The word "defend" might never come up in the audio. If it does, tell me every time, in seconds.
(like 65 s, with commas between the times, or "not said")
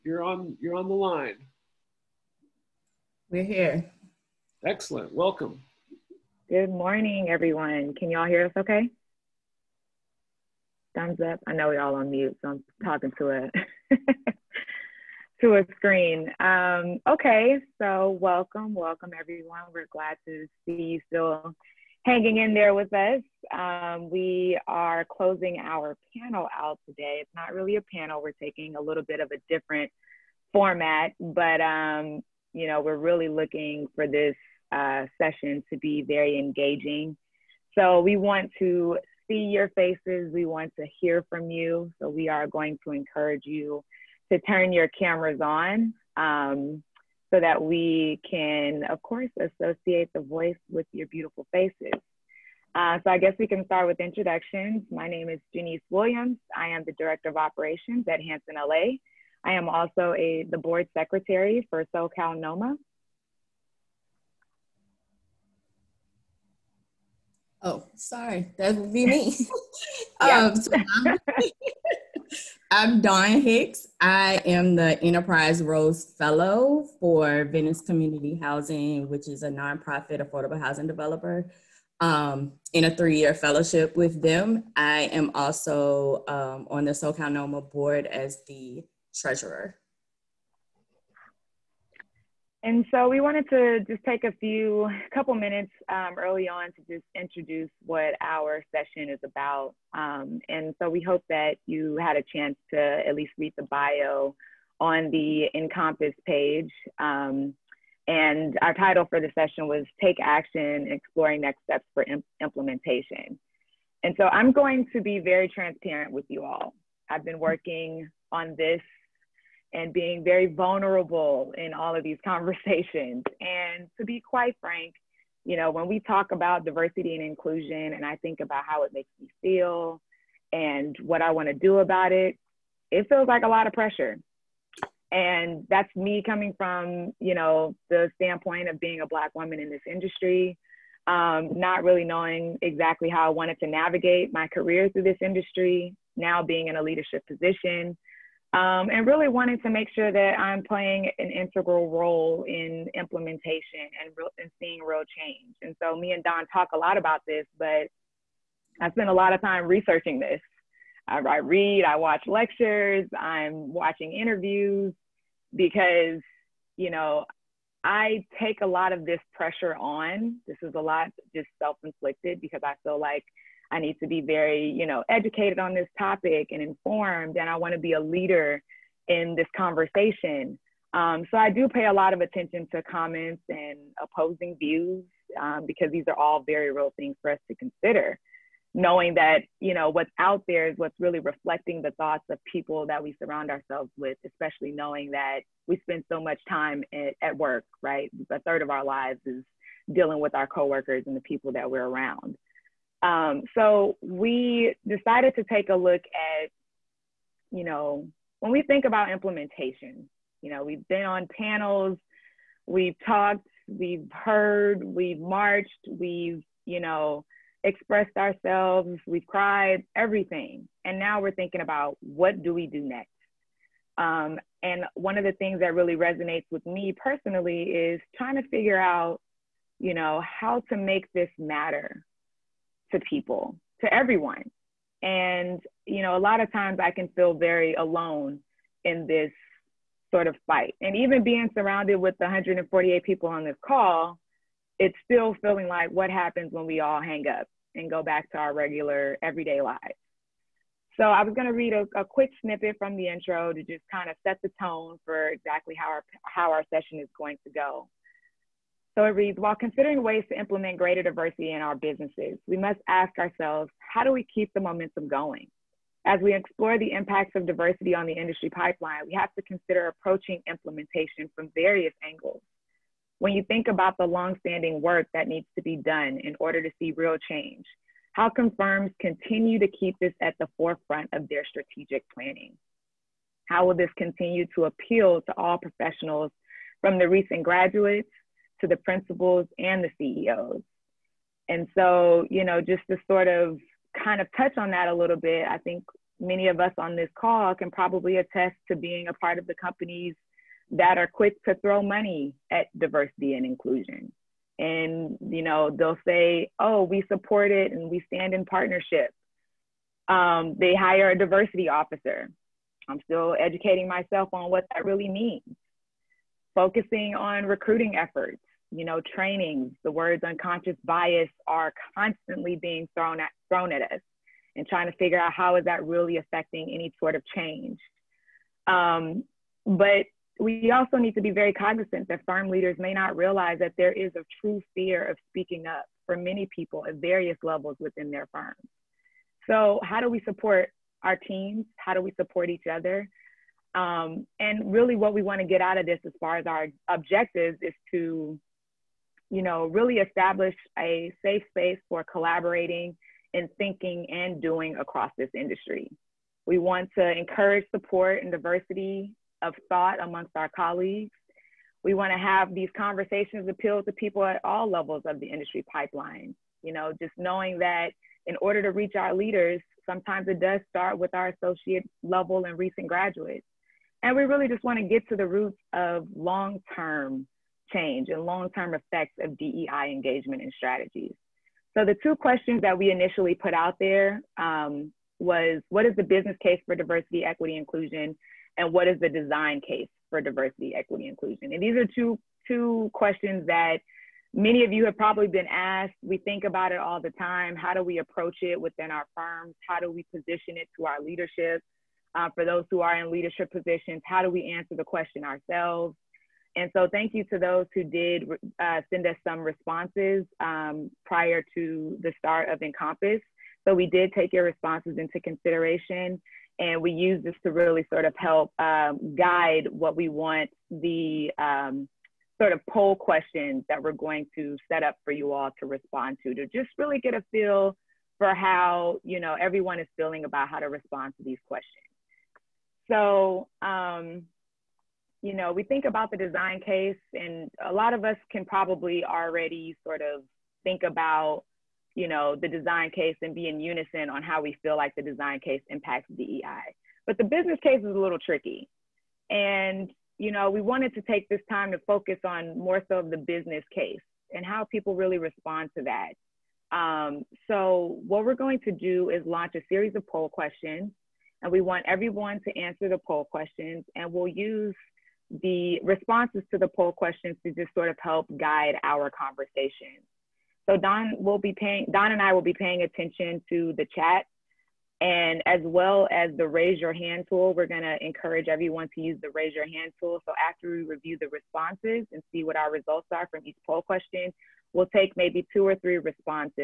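not said.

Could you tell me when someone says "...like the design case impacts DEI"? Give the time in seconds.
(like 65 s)
444 s.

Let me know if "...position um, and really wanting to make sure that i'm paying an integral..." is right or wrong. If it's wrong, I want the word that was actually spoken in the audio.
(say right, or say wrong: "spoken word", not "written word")
wrong: "playing", not "paying".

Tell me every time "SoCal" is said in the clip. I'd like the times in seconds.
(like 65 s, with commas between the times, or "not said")
61 s, 86 s.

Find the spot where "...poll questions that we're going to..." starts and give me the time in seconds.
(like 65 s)
422 s.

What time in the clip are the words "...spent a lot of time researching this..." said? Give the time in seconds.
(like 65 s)
158 s.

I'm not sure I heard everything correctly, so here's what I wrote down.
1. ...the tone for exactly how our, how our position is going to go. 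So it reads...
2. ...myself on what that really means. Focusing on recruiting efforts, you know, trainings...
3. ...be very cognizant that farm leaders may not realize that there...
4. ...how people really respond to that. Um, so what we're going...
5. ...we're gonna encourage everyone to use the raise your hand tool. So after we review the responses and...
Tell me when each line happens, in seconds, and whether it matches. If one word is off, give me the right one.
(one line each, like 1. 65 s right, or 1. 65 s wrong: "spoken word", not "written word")
1. 254 s wrong: "session", not "position"
2. 313 s right
3. 331 s right
4. 454 s right
5. 477 s right.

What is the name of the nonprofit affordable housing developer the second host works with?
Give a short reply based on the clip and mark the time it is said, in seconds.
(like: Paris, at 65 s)
Venice Community Housing, at 77 s.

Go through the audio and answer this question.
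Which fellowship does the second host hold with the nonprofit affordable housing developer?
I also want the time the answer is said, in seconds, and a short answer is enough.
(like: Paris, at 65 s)
Enterprise Rose Fellow, at 75 s.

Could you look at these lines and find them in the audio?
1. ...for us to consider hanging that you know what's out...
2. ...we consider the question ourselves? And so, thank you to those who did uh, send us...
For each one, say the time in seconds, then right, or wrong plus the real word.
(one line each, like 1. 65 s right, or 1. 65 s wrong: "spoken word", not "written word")
1. 187 s wrong: "knowing", not "hanging"
2. 404 s wrong: "answer", not "consider".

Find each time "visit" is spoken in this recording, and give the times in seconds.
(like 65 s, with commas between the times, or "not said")
not said.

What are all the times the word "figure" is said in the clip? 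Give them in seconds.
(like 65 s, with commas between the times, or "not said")
228 s, 324 s.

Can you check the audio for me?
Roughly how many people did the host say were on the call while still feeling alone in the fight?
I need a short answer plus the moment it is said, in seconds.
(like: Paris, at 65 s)
148, at 242 s.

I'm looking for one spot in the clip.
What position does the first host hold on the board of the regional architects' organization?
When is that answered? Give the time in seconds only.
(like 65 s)
60 s.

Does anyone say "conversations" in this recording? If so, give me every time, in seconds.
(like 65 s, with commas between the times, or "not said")
122 s, 179 s, 362 s, 469 s.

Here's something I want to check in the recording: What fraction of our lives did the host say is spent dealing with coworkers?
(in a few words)
A third.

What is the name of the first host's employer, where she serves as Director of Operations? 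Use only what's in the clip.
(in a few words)
Hanson LA.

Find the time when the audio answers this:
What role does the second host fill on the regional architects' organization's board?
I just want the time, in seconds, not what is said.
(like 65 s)
89 s.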